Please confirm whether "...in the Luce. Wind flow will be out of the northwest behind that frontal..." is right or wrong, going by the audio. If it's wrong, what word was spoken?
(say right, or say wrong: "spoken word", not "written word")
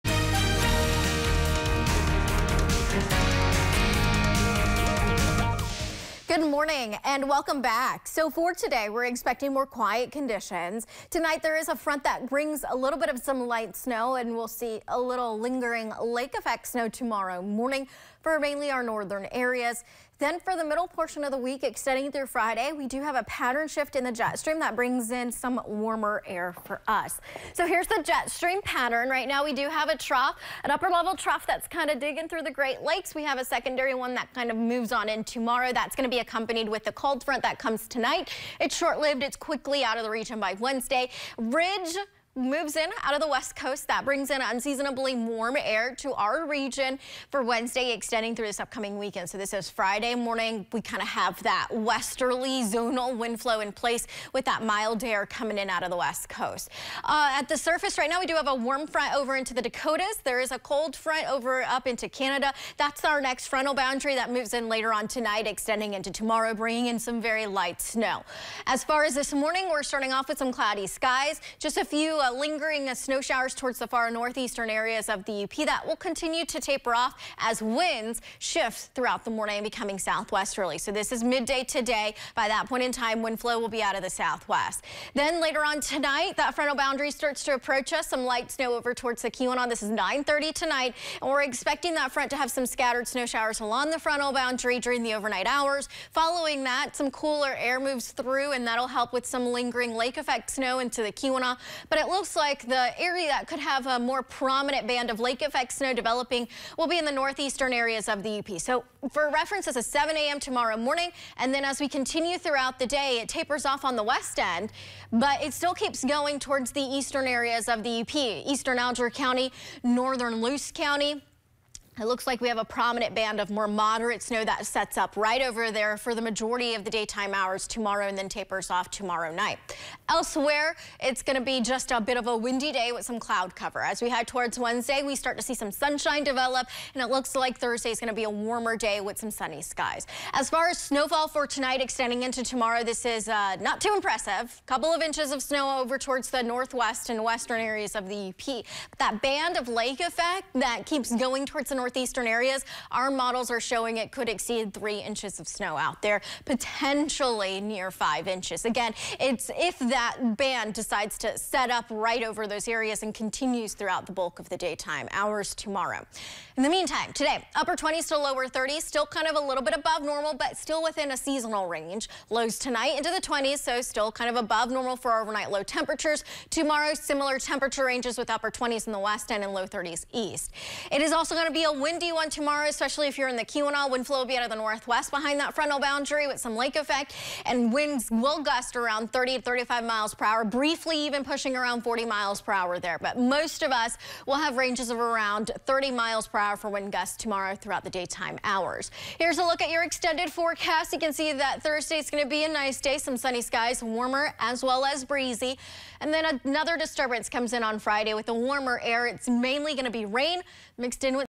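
wrong: "Keweenaw", not "Luce".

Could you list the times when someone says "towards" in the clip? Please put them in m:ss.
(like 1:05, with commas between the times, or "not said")
1:13, 1:28, 1:56, 2:14, 2:25, 2:31.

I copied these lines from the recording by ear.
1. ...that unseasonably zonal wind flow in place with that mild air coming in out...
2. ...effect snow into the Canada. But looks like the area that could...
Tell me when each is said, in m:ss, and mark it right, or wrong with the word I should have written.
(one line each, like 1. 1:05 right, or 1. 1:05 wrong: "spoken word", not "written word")
1. 0:51 wrong: "westerly", not "unseasonably"
2. 1:40 wrong: "Keweenaw", not "Canada".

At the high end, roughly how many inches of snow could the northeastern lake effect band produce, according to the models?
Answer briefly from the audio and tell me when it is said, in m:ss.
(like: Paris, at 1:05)
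5 inches, at 2:37.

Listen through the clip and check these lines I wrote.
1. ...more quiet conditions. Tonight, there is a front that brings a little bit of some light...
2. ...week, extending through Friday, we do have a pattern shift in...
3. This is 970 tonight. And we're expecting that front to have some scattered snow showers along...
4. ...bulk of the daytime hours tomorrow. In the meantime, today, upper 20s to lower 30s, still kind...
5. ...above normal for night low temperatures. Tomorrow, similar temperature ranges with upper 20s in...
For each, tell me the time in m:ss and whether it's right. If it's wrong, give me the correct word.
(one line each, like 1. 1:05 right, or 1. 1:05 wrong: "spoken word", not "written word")
1. 0:09 right
2. 0:21 right
3. 1:29 wrong: "930", not "970"
4. 2:44 right
5. 2:54 wrong: "overnight", not "night".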